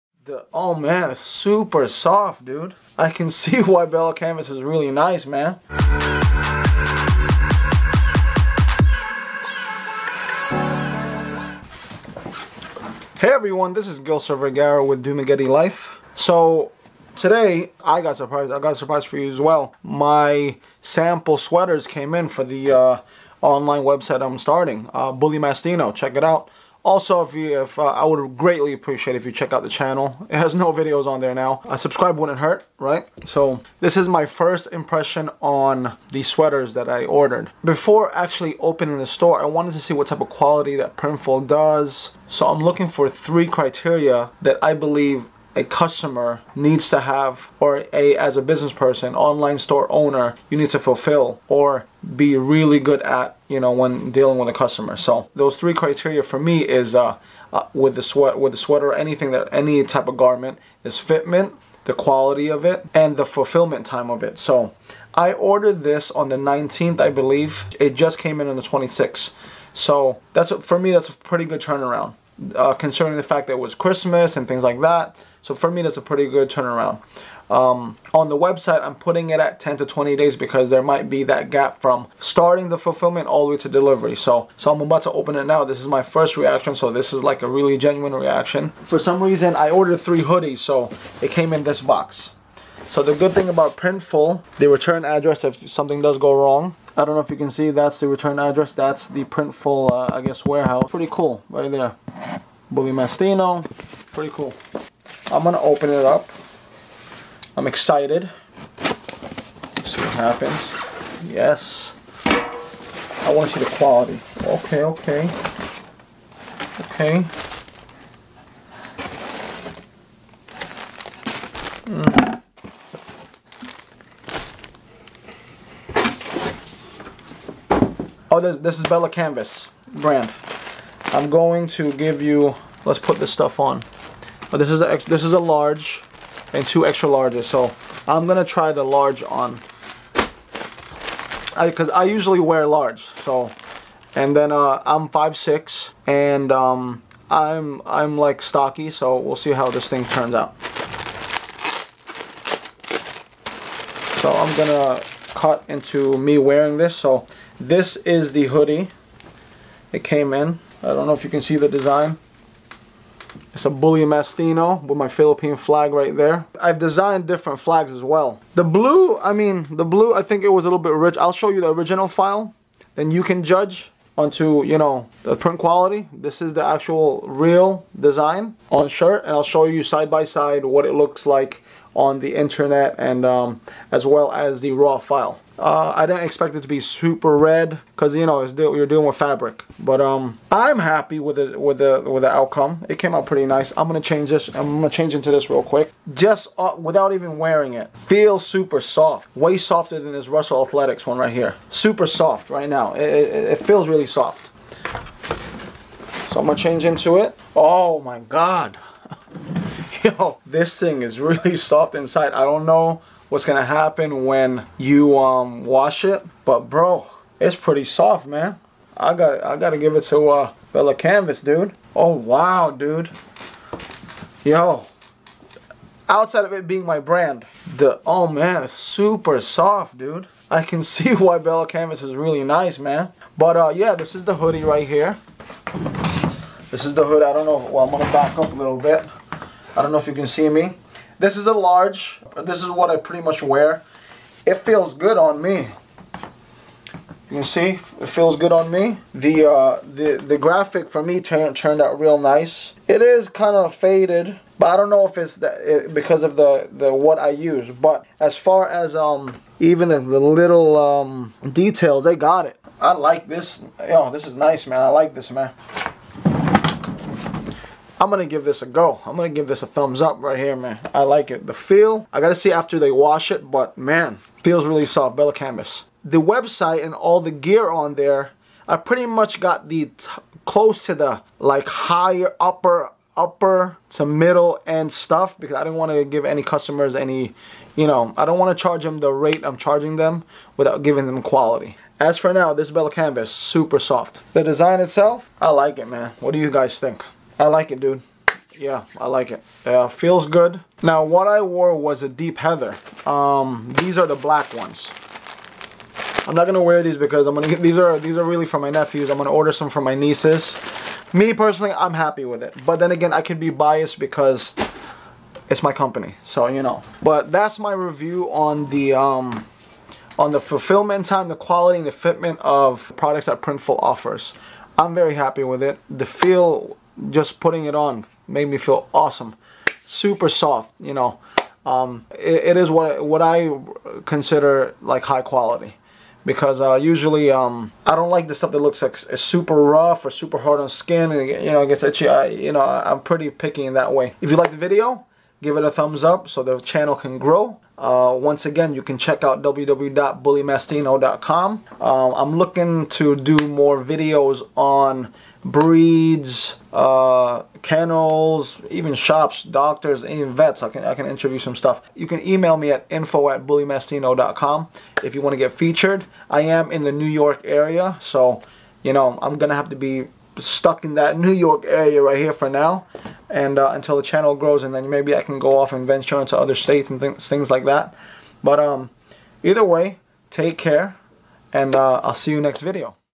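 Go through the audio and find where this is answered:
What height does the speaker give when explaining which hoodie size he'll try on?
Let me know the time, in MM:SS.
02:25.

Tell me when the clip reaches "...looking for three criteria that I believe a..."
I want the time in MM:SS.
00:42.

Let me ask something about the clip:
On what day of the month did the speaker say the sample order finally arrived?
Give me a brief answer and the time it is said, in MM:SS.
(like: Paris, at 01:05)
26th, at 01:08.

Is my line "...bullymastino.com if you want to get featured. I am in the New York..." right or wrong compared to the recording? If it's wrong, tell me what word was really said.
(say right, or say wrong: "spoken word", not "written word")
right.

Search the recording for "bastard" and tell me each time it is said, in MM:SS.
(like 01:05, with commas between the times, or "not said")
not said.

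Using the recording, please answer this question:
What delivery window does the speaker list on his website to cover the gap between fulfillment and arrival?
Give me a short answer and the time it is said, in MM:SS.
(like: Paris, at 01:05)
10 to 20 days, at 01:19.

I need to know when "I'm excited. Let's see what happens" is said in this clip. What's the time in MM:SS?
01:47.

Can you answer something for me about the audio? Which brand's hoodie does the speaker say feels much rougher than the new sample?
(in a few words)
Russell Athletics.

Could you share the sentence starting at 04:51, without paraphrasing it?
As for now, this Bella Canvas, super soft.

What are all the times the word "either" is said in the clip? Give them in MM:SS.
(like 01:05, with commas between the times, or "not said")
06:19.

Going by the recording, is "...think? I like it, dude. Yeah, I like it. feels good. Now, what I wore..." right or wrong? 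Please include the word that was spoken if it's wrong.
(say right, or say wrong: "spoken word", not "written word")
right.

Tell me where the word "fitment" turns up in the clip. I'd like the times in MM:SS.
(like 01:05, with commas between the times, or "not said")
01:00, 05:21.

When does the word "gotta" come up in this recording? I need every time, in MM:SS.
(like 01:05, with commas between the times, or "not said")
03:39.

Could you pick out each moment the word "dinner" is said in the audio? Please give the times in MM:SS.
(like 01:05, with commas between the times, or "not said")
not said.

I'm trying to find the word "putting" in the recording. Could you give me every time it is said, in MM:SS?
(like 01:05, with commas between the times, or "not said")
01:18, 05:27.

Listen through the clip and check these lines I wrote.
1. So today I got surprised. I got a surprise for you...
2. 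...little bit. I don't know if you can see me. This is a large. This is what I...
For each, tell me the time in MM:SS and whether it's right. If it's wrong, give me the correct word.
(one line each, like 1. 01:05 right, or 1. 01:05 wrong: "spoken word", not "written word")
1. 00:16 right
2. 03:58 right.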